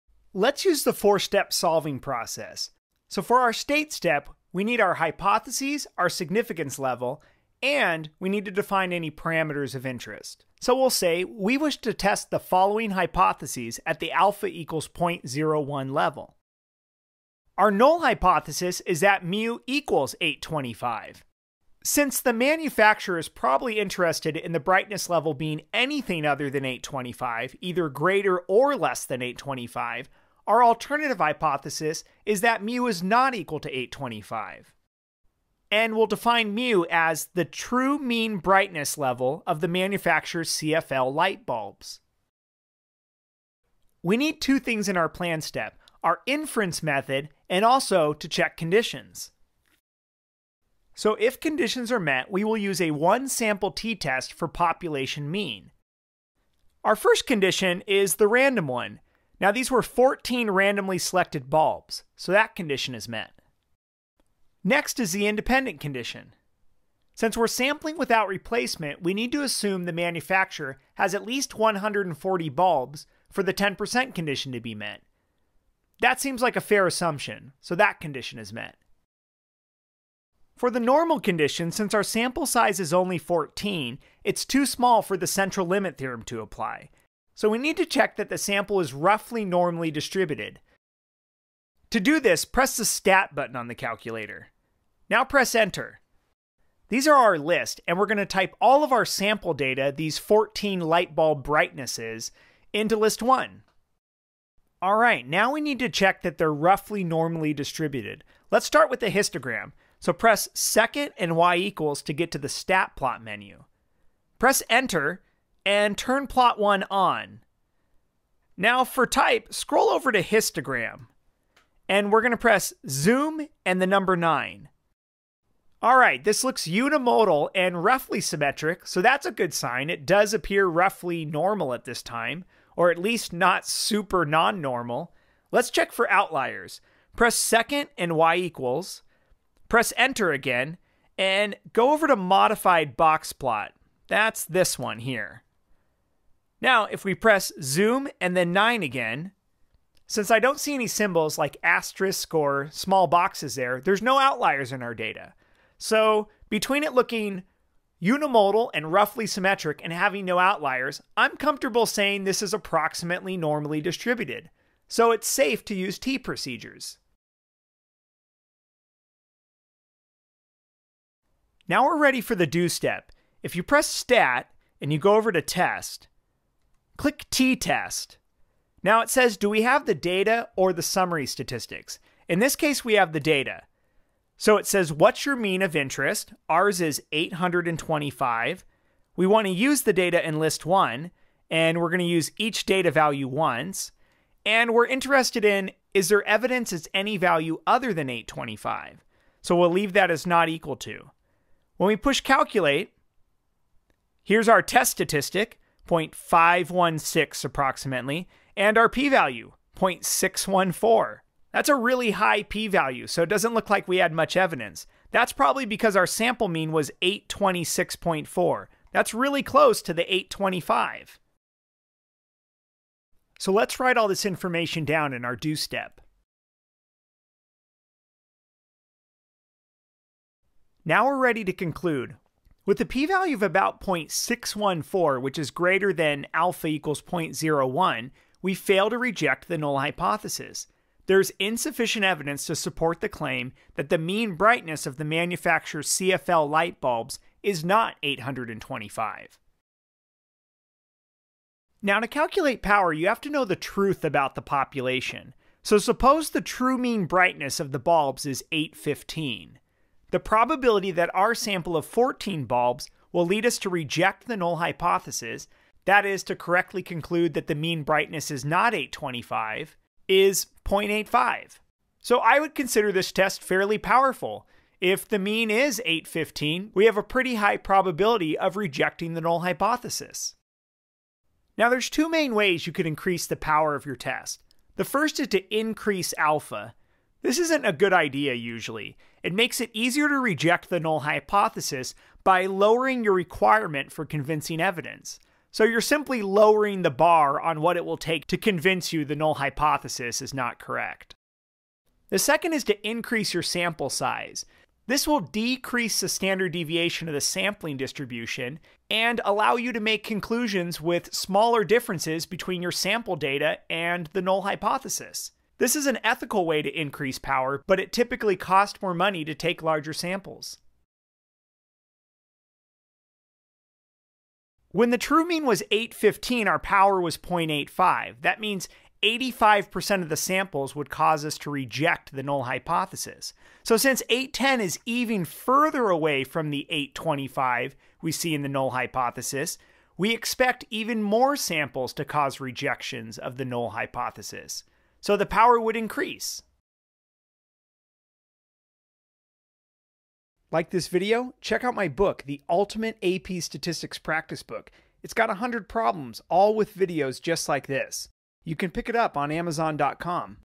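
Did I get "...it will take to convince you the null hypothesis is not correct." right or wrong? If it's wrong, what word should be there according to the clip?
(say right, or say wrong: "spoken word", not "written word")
right.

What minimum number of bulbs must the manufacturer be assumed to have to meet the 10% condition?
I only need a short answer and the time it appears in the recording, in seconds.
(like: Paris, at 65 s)
140, at 71 s.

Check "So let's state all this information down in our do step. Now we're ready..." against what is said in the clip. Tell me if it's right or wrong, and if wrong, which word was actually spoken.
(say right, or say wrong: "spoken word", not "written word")
wrong: "write", not "state".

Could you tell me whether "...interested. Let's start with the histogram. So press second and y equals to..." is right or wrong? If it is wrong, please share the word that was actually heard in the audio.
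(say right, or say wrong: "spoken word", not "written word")
wrong: "distributed", not "interested".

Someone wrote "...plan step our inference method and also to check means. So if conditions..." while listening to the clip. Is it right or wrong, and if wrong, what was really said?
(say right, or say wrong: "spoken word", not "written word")
wrong: "conditions", not "means".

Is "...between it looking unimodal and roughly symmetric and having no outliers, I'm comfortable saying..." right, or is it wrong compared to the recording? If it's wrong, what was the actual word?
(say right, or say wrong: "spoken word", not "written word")
right.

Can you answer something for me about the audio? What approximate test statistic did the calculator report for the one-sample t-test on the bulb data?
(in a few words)
0.516.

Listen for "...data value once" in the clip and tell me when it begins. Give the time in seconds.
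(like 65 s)
192 s.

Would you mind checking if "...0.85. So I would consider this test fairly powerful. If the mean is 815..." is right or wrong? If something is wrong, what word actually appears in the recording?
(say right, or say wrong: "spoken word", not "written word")
right.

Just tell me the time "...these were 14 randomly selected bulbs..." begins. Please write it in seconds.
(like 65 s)
59 s.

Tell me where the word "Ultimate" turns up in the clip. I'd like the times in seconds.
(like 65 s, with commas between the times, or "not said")
352 s.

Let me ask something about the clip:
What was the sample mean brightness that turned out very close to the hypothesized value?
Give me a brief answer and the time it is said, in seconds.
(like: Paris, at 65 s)
826.4, at 217 s.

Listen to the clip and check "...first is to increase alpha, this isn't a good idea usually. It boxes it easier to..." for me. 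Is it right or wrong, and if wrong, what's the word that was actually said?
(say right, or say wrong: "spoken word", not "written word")
wrong: "makes", not "boxes".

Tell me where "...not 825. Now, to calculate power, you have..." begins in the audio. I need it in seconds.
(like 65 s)
247 s.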